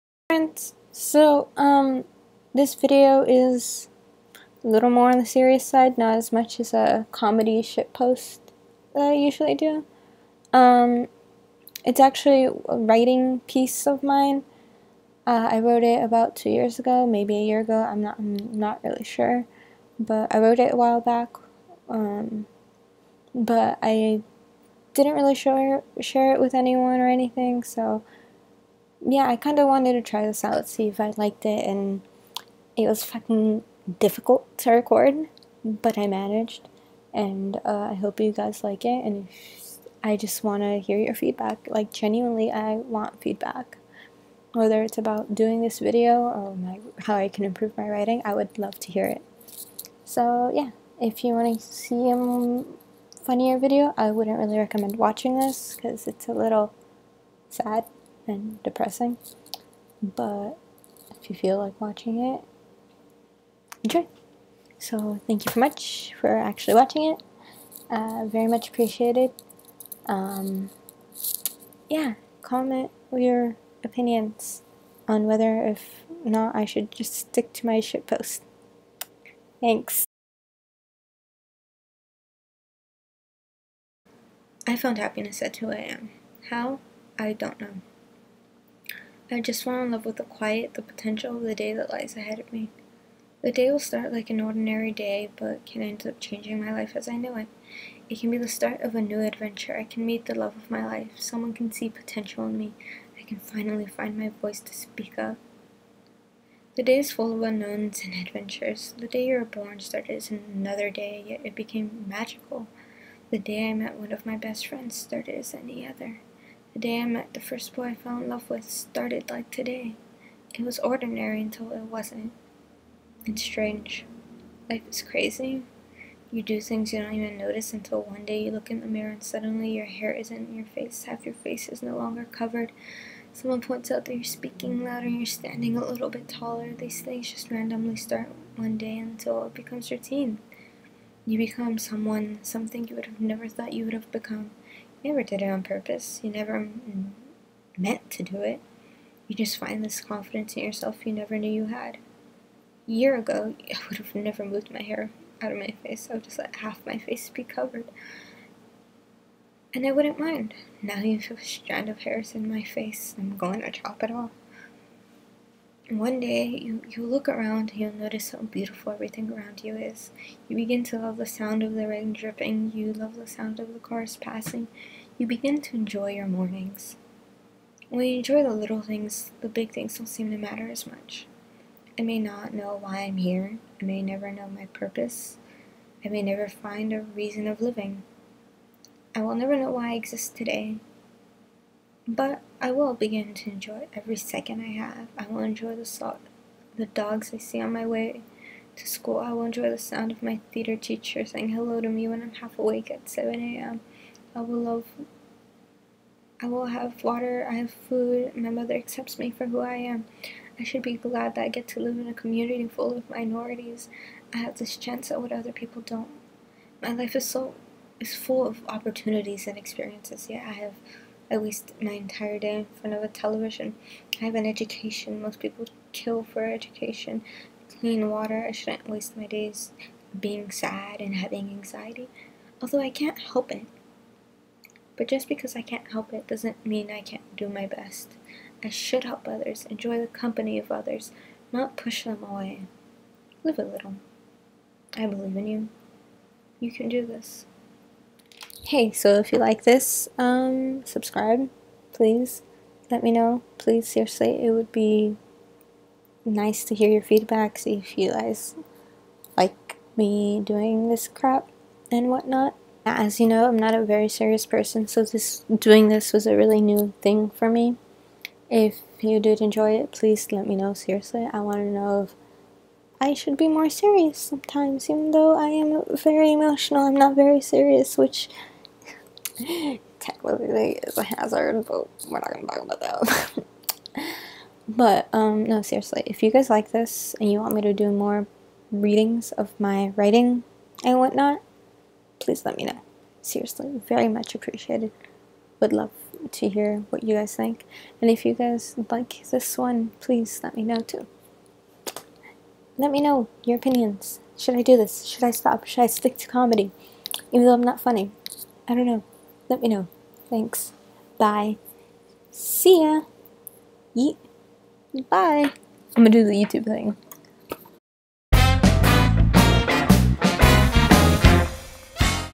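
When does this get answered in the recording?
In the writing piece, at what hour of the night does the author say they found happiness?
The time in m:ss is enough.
1:25.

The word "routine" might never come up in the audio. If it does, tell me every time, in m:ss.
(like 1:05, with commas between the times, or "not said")
2:19.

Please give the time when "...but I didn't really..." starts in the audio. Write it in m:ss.
0:23.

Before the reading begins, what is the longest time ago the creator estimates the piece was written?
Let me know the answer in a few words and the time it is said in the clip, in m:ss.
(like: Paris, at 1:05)
2 years ago, at 0:16.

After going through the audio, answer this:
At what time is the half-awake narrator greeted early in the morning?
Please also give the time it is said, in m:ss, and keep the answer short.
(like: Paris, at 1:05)
7 a.m., at 3:23.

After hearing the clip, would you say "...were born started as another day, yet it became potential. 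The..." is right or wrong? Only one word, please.
wrong.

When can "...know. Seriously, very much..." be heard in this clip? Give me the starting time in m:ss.
4:52.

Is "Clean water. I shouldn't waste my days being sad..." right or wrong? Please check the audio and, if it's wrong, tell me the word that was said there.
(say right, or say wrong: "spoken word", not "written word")
right.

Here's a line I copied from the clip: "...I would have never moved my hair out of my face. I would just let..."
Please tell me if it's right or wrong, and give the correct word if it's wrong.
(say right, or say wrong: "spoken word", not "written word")
right.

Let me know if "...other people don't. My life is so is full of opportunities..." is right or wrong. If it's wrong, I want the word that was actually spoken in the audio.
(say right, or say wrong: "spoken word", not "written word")
right.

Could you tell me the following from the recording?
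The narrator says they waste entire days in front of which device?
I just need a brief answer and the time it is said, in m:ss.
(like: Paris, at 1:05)
Television, at 3:43.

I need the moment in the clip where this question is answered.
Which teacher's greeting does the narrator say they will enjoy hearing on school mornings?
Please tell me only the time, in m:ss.
3:20.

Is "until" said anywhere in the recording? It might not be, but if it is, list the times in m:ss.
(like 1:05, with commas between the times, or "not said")
2:01, 2:07, 2:18.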